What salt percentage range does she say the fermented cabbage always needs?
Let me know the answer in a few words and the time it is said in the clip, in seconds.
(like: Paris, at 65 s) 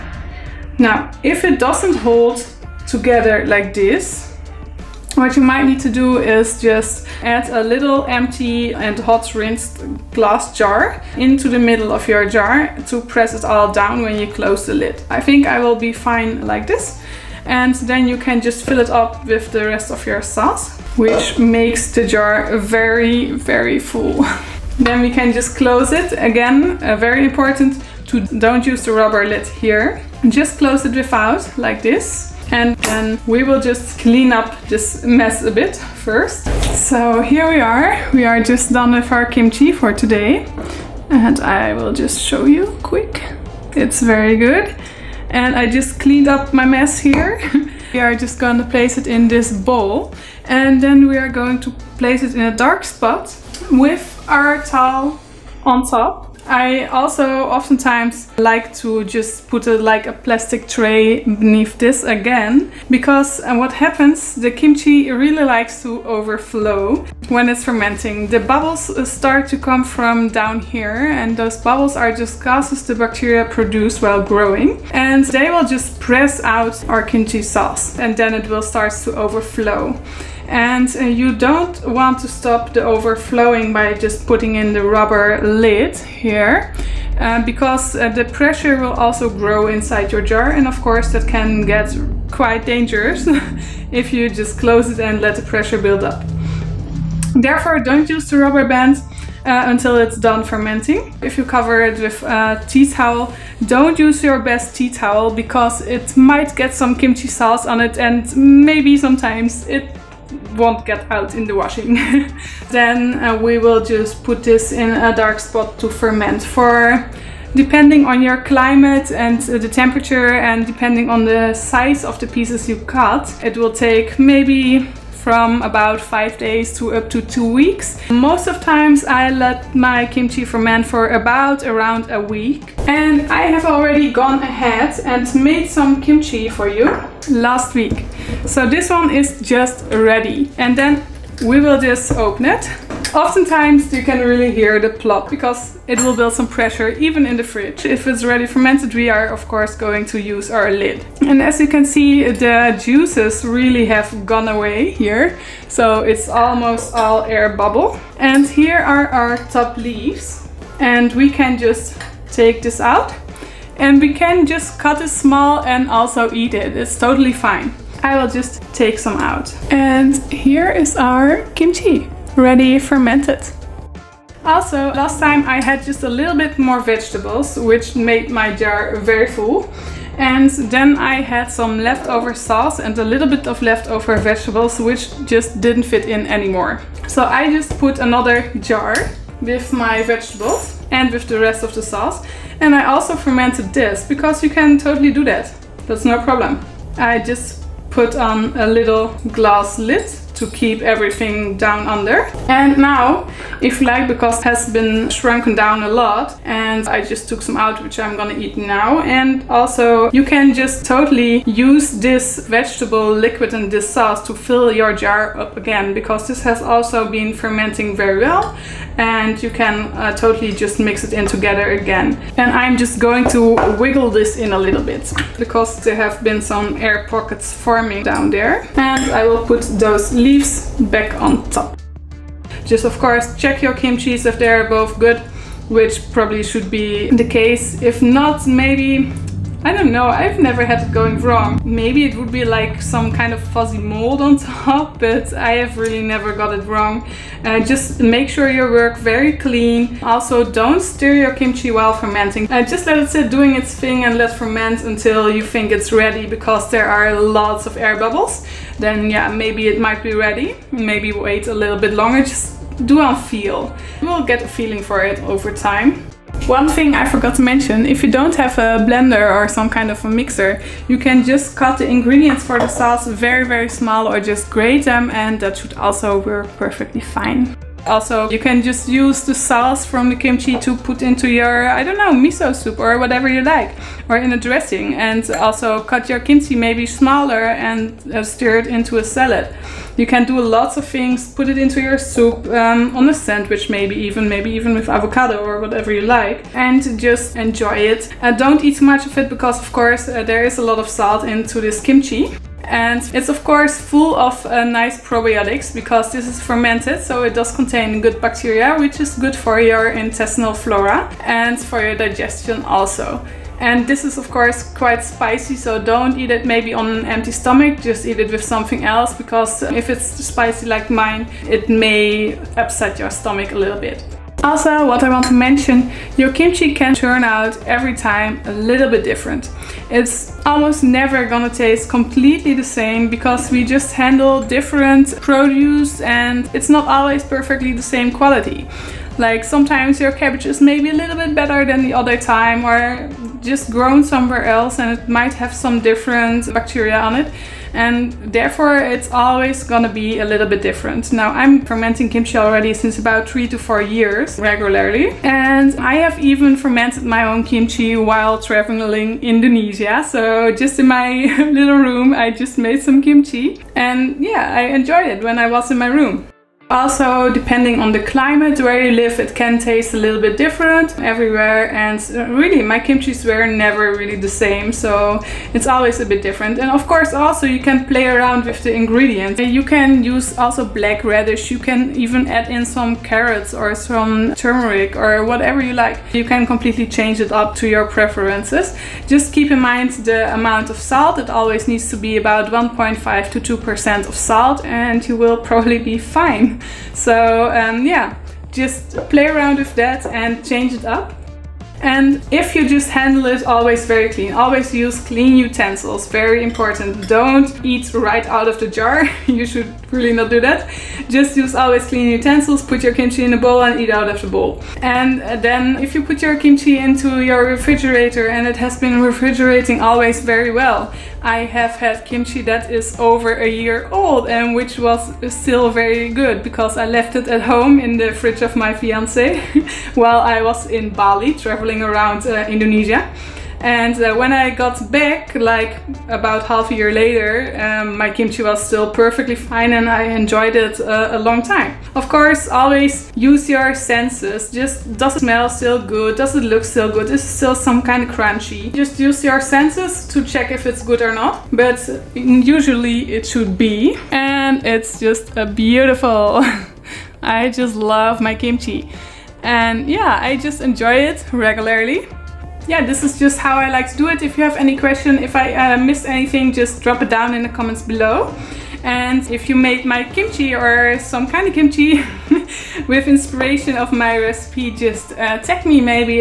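1.5 to 2%, at 392 s.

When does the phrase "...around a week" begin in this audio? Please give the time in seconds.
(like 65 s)
131 s.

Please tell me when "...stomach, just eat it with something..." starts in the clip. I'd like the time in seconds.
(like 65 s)
317 s.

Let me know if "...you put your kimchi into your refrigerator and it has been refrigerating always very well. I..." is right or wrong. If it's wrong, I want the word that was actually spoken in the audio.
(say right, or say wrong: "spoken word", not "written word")
right.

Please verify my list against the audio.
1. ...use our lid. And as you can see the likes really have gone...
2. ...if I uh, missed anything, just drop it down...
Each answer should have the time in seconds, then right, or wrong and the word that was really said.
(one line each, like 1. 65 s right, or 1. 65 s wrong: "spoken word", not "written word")
1. 150 s wrong: "juices", not "likes"
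2. 465 s right.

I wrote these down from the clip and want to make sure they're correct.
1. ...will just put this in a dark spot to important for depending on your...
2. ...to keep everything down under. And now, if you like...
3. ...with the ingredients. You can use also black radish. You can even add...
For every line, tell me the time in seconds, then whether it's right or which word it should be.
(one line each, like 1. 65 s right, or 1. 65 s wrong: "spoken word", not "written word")
1. 113 s wrong: "ferment", not "important"
2. 200 s right
3. 378 s right.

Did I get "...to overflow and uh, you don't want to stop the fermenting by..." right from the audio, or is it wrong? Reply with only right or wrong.
wrong.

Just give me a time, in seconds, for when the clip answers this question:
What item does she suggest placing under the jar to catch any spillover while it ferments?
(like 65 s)
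60 s.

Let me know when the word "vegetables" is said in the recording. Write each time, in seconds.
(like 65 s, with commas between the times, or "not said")
176 s, 184 s, 190 s, 212 s.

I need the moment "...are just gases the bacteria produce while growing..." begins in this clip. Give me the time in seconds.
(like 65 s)
71 s.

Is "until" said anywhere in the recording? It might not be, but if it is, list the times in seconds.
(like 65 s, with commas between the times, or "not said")
99 s, 254 s.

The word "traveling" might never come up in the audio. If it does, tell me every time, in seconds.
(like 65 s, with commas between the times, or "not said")
358 s, 431 s.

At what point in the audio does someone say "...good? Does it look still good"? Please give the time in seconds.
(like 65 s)
445 s.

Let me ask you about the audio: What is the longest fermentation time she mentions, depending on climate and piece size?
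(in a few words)
2 weeks.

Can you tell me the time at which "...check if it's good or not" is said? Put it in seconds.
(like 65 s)
450 s.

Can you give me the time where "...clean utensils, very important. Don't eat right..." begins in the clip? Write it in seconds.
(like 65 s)
405 s.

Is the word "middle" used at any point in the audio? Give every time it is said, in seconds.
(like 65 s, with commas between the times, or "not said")
11 s.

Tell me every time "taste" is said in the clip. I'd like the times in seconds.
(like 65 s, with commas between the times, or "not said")
331 s, 369 s.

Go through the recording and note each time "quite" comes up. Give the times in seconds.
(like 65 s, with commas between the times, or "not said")
92 s, 314 s.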